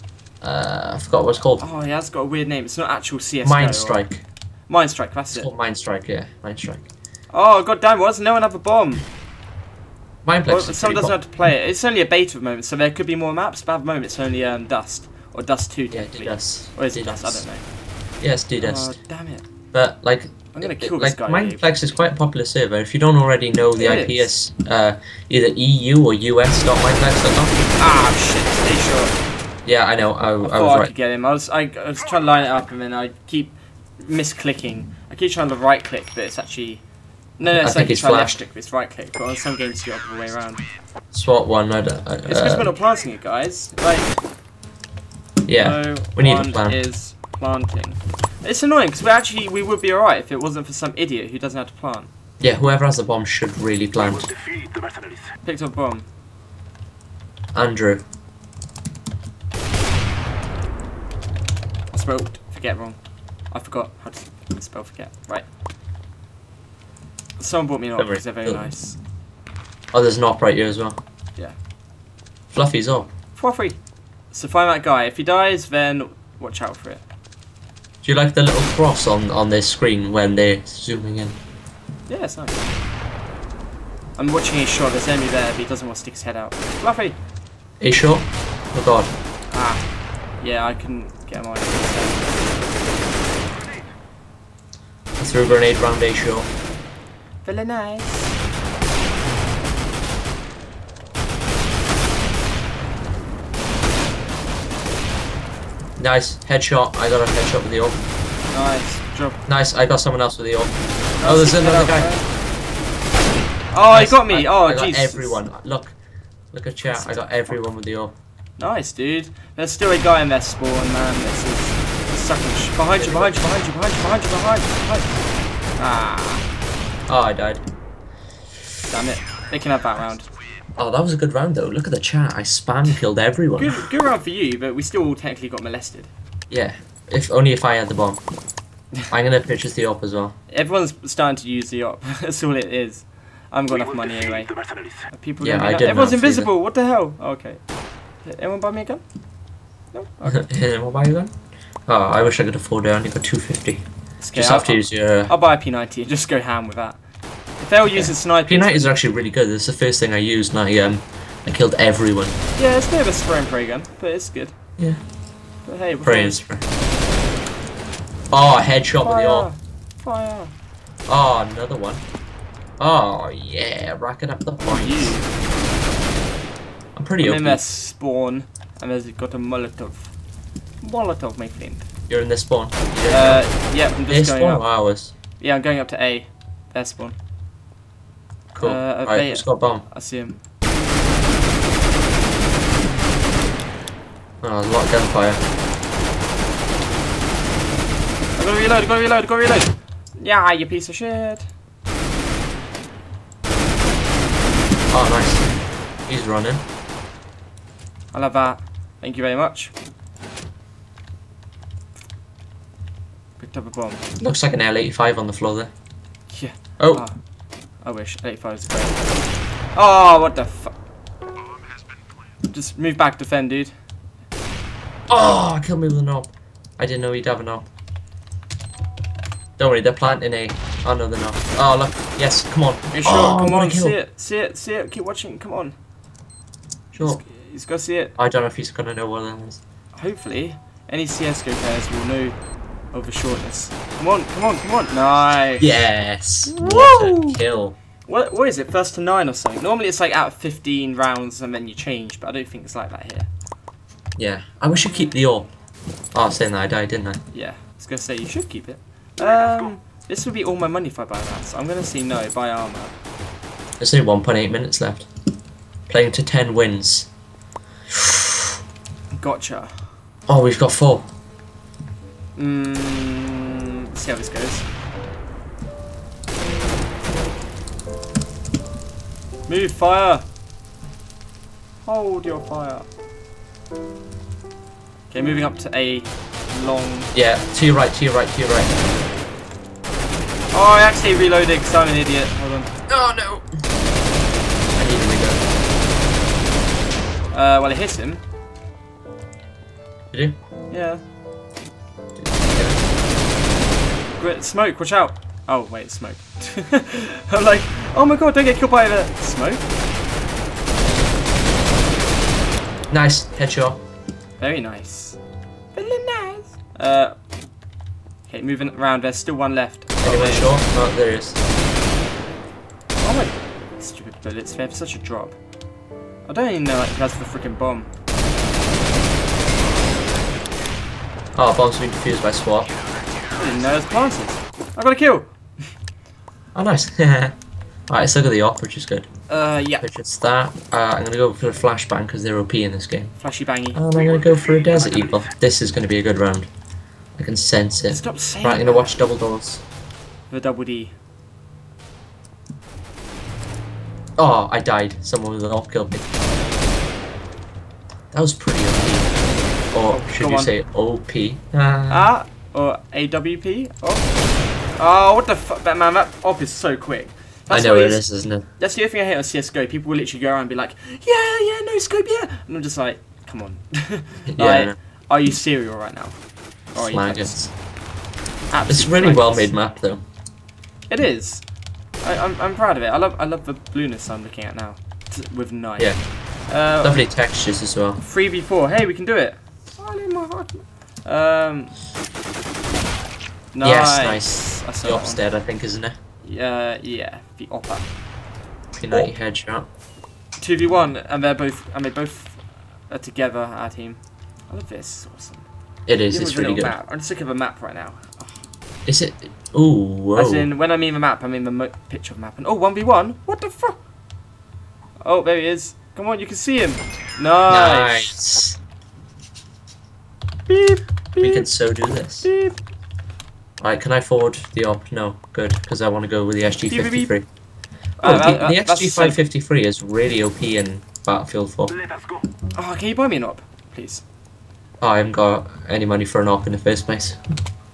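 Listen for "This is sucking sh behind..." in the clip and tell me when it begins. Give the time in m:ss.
2:01.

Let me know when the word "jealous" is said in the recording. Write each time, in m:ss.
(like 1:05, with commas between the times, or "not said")
not said.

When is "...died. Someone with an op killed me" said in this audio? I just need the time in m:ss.
5:54.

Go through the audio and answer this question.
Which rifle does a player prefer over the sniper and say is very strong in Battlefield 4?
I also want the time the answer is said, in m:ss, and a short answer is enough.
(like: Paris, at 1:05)
SG-553, at 7:08.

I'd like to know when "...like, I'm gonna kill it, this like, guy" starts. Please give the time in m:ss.
0:20.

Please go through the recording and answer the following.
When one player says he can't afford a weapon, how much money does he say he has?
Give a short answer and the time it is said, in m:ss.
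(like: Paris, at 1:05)
250, at 2:32.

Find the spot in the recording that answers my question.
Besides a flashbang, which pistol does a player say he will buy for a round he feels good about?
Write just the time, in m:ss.
5:44.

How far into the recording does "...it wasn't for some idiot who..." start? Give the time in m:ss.
0:50.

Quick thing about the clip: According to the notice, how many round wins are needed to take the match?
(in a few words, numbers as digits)
10.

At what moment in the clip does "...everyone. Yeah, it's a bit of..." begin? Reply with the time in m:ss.
2:41.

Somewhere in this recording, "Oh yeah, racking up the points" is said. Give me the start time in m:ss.
2:52.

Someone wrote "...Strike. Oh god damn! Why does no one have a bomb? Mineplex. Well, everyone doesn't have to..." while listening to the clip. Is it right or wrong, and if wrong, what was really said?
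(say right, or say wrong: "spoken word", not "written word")
wrong: "someone", not "everyone".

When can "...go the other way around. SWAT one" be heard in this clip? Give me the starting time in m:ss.
0:39.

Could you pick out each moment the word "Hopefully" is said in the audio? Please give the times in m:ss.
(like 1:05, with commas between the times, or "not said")
3:59.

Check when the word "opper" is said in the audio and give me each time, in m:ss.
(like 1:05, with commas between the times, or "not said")
6:37.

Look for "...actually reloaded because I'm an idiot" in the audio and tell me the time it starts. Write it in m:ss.
4:50.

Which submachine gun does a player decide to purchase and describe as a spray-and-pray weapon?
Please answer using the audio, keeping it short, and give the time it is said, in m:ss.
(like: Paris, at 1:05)
P90, at 2:35.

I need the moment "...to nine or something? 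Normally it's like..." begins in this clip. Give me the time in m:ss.
4:08.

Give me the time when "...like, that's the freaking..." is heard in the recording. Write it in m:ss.
5:26.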